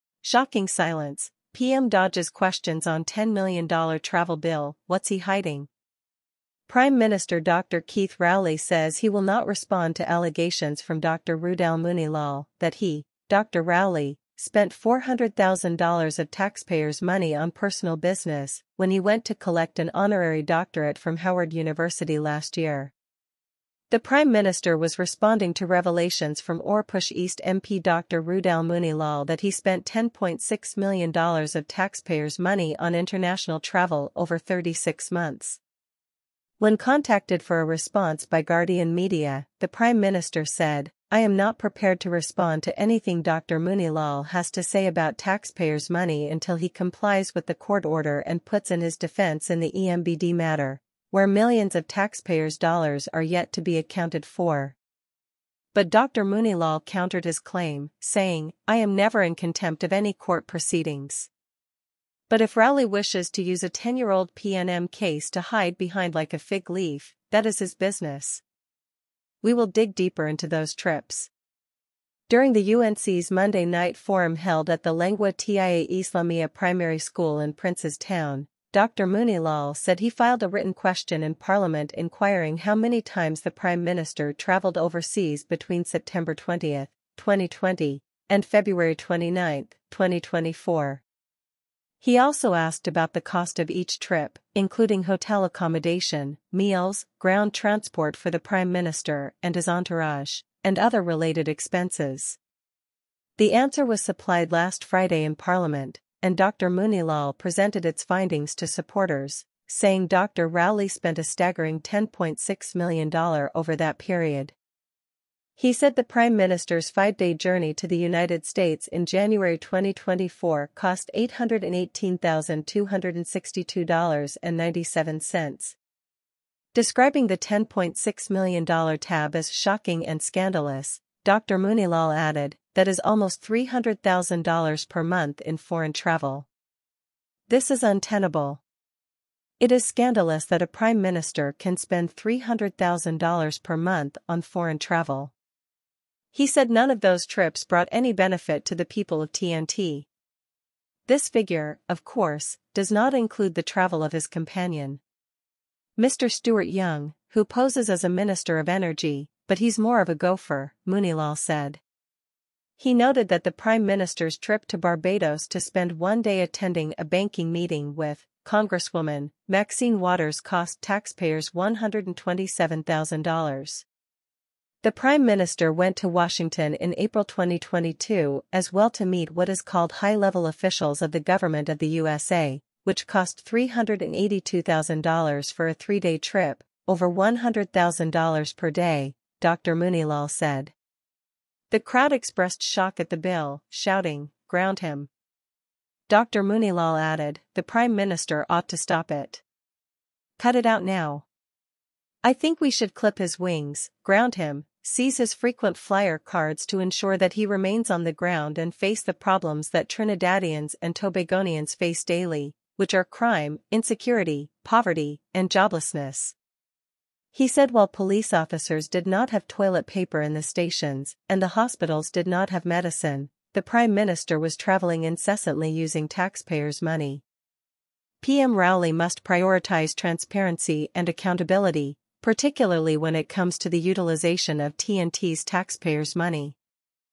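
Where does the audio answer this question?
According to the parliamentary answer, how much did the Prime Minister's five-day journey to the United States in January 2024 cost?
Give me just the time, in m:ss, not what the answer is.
2:01.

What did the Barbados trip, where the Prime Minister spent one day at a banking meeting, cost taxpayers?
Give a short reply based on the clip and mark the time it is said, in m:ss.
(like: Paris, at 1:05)
$127,000, at 2:51.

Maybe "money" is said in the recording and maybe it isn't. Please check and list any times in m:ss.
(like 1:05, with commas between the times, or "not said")
0:17, 0:32, 0:45, 3:46, 3:56.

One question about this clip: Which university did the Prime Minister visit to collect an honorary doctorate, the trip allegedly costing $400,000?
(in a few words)
Howard University.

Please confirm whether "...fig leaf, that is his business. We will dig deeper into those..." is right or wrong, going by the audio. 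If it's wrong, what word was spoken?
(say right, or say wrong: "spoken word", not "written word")
right.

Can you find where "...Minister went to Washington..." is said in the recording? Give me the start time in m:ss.
2:55.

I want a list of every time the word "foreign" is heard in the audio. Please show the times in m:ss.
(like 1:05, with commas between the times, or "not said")
2:15, 2:24.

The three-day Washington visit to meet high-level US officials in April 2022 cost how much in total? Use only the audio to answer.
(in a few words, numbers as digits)
$382,000.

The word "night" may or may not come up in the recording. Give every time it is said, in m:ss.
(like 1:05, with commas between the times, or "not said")
1:13.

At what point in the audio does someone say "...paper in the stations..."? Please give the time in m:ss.
3:39.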